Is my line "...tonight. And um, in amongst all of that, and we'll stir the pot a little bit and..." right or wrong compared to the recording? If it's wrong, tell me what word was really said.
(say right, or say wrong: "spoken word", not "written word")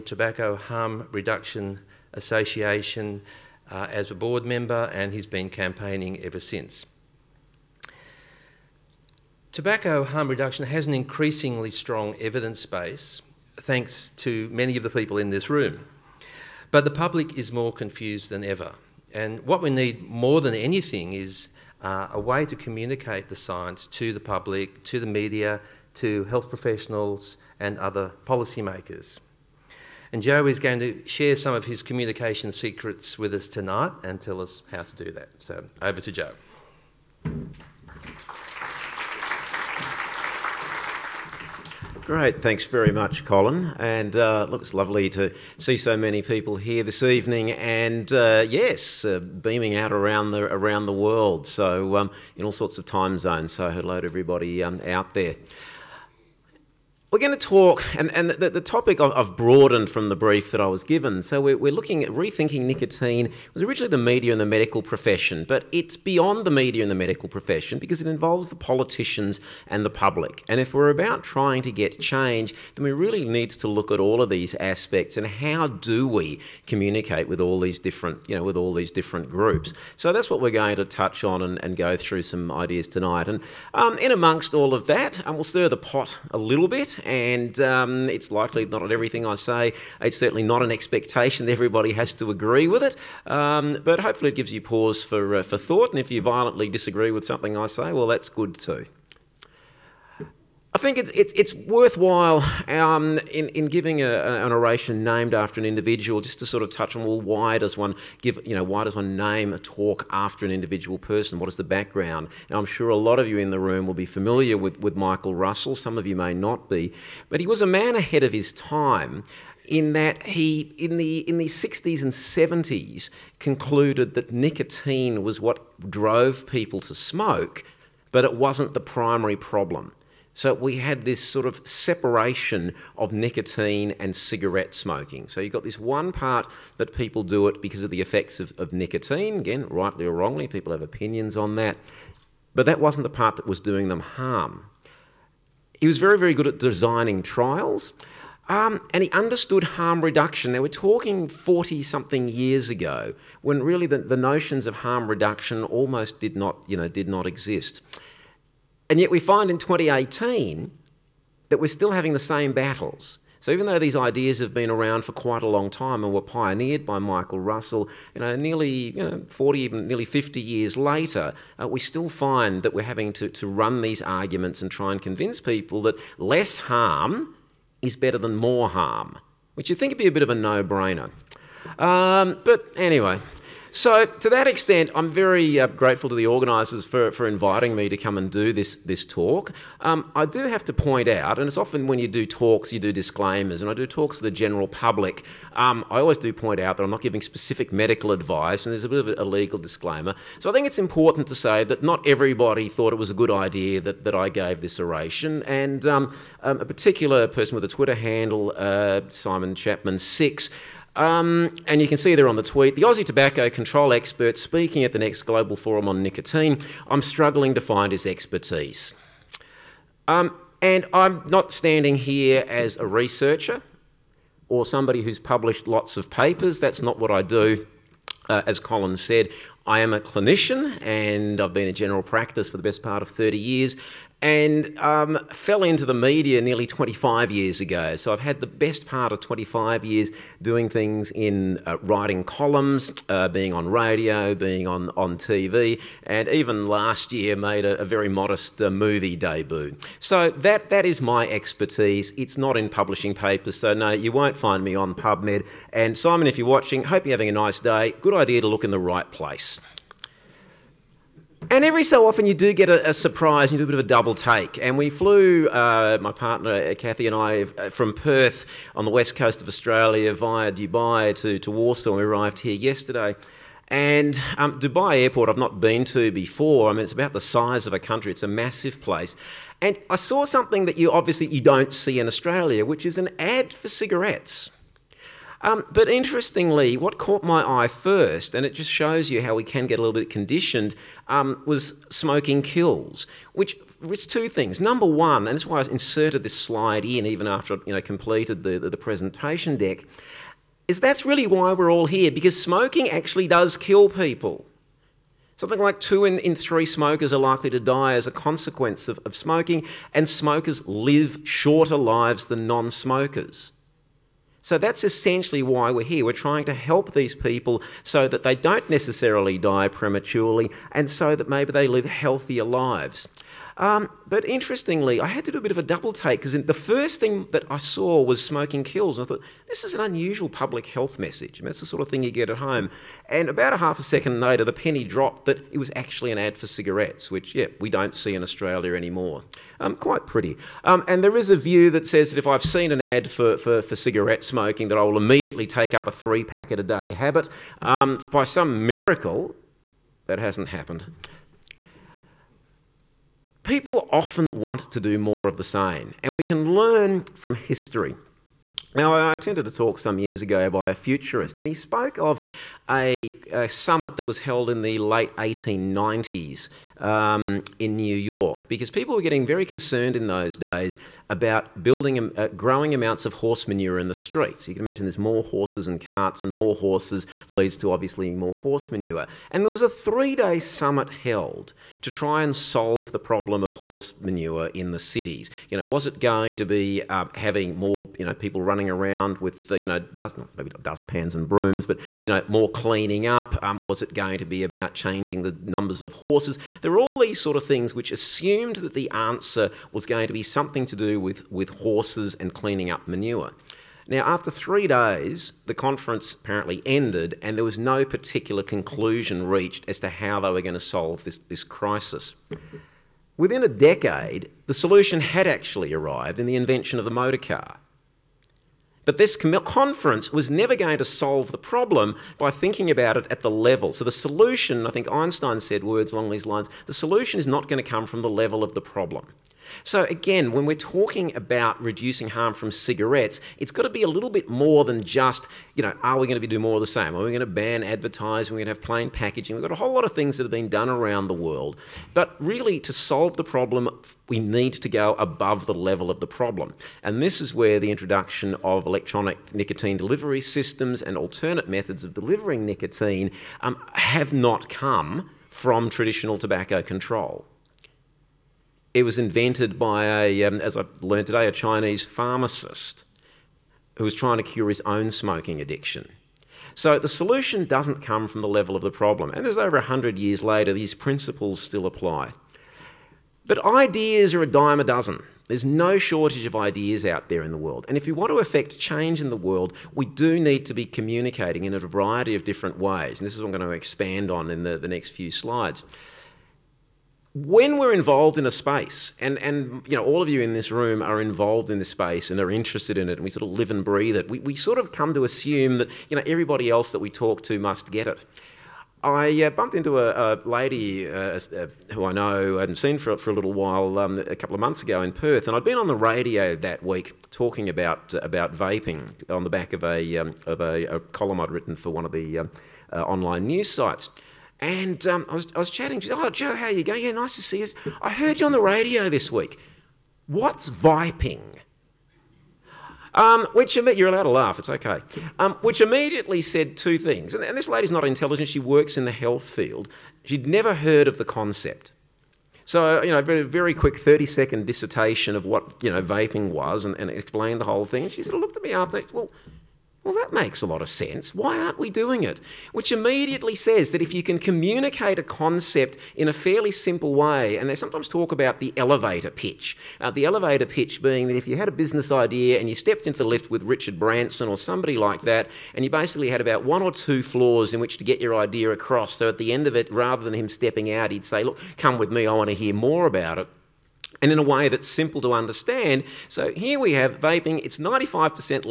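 right.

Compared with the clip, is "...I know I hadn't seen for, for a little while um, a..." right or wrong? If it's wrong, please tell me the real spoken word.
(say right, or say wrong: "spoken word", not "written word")
right.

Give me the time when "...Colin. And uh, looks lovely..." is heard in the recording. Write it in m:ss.
0:43.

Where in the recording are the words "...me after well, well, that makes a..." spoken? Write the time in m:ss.
8:58.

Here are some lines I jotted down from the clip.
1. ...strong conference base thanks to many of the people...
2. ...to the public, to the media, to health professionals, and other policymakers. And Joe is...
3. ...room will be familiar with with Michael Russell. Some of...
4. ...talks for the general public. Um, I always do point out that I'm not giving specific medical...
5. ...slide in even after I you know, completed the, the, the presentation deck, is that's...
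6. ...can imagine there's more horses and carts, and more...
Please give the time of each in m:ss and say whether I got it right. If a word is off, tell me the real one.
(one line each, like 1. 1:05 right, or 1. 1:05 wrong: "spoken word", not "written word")
1. 0:11 wrong: "evidence", not "conference"
2. 0:23 right
3. 1:53 right
4. 3:13 right
5. 4:56 right
6. 6:14 right.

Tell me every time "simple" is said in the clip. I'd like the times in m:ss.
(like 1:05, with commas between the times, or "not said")
9:06, 9:24.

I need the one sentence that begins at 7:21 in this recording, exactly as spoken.
But really, to solve the problem, we need to go above the level of the problem.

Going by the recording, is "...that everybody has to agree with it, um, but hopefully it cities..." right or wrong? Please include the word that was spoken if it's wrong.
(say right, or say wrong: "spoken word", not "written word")
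wrong: "gives", not "cities".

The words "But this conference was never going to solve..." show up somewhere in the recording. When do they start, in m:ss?
6:58.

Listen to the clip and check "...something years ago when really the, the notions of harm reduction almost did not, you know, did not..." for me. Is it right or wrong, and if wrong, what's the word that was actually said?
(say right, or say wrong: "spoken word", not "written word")
right.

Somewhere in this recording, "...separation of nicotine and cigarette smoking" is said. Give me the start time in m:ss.
2:11.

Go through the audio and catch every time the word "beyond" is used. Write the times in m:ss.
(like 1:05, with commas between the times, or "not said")
1:05.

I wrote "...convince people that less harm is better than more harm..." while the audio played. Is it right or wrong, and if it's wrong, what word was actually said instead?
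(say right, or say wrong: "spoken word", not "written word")
right.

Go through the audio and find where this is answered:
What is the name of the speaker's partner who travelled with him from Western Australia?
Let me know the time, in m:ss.
4:26.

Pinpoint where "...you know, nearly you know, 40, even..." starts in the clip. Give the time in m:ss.
2:48.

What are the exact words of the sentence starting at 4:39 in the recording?
And I saw something that you obviously you don't see in Australia, which is an ad for cigarettes.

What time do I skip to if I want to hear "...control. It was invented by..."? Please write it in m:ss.
7:36.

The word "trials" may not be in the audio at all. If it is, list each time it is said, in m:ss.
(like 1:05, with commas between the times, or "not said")
2:27.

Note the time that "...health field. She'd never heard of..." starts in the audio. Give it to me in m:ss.
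8:48.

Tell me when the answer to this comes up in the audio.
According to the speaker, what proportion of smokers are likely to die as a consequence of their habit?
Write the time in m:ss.
5:05.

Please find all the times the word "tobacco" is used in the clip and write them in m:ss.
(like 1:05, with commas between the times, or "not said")
0:00, 0:09, 3:33, 7:36.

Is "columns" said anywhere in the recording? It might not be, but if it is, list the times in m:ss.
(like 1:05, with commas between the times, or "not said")
4:02, 8:30.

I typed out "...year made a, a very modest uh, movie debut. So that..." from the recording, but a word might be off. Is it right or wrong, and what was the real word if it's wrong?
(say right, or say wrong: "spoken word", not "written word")
right.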